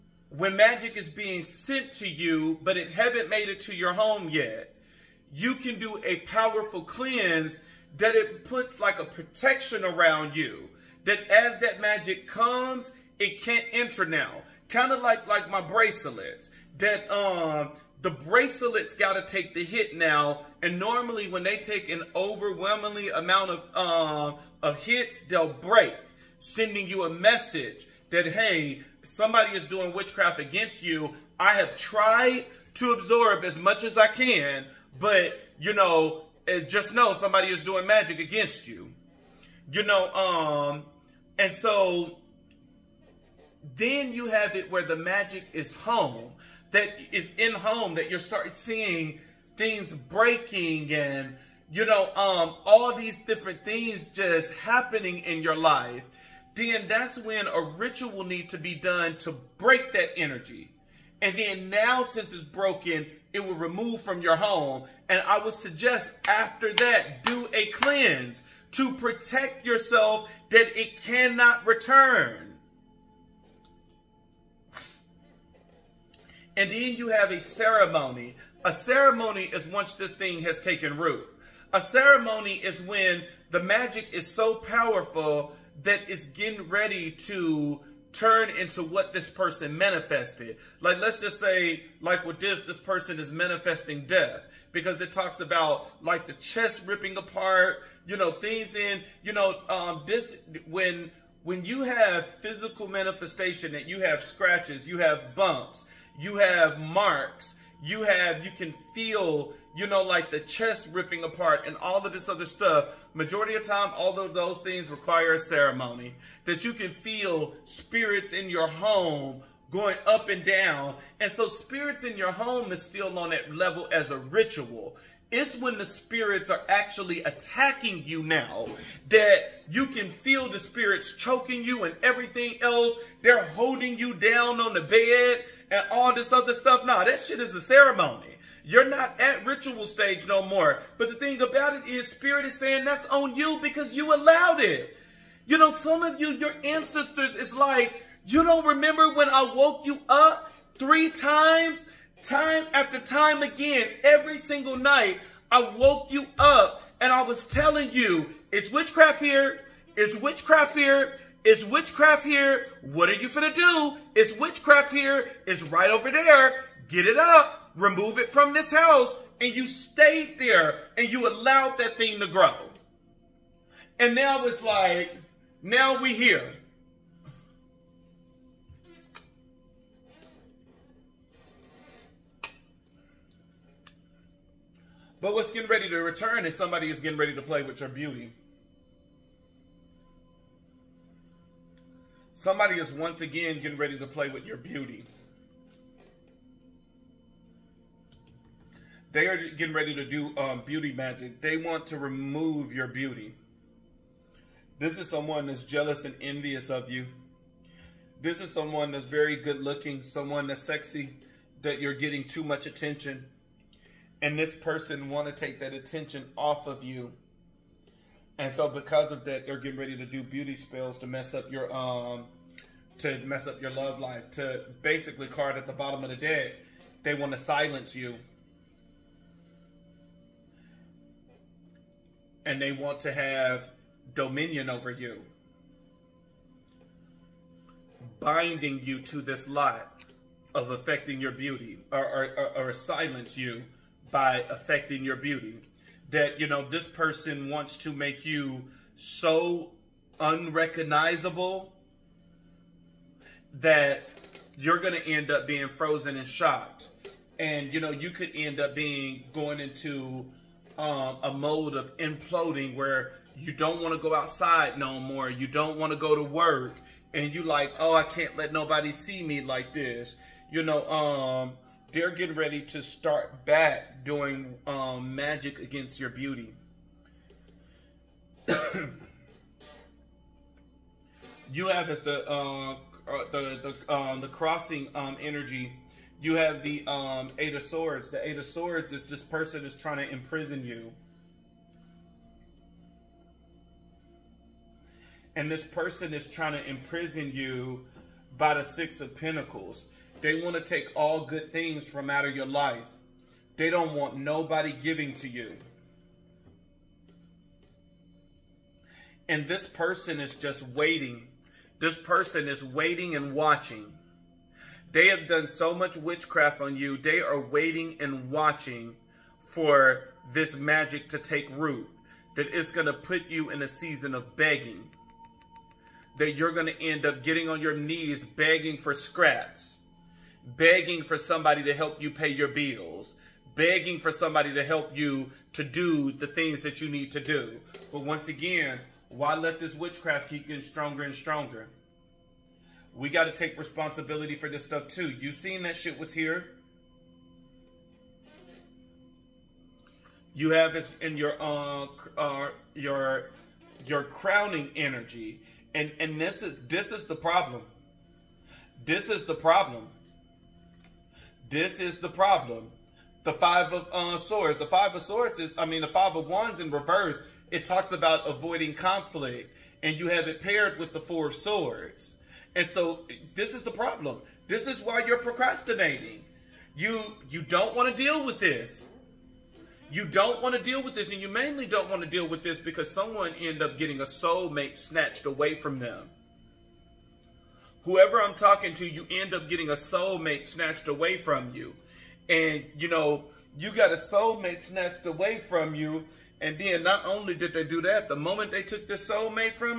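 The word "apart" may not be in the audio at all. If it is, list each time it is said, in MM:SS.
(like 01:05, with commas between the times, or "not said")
01:37, 01:51.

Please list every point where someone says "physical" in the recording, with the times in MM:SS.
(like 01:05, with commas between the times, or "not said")
01:42.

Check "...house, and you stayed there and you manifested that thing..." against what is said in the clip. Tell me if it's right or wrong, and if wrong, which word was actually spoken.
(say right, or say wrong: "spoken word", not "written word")
wrong: "allowed", not "manifested".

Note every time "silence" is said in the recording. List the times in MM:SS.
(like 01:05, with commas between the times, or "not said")
03:47, 04:02.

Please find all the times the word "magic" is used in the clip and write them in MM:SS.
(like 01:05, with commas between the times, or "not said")
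00:00, 00:11, 00:37, 00:44, 01:23, 03:20, 04:35, 05:20.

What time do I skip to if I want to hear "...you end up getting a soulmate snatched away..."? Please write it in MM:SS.
06:28.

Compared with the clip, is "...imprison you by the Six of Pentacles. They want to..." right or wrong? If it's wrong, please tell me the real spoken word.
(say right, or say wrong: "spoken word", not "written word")
right.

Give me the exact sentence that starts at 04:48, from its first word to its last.
The Eight of Swords is this person is trying to imprison you.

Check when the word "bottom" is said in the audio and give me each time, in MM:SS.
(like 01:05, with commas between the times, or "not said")
03:45.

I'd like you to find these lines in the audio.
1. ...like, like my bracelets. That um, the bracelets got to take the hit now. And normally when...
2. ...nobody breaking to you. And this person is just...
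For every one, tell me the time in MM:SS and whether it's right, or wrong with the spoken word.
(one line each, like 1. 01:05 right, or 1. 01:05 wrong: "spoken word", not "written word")
1. 00:15 right
2. 05:04 wrong: "giving", not "breaking".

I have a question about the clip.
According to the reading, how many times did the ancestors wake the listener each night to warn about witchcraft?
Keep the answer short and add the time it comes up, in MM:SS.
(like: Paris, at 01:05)
3, at 02:30.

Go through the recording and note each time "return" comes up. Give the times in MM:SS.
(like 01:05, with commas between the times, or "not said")
01:11, 03:05.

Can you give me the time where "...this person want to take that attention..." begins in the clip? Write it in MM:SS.
03:34.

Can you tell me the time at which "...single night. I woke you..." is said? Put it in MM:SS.
02:34.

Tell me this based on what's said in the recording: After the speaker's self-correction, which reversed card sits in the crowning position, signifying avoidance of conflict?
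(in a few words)
Five of Wands.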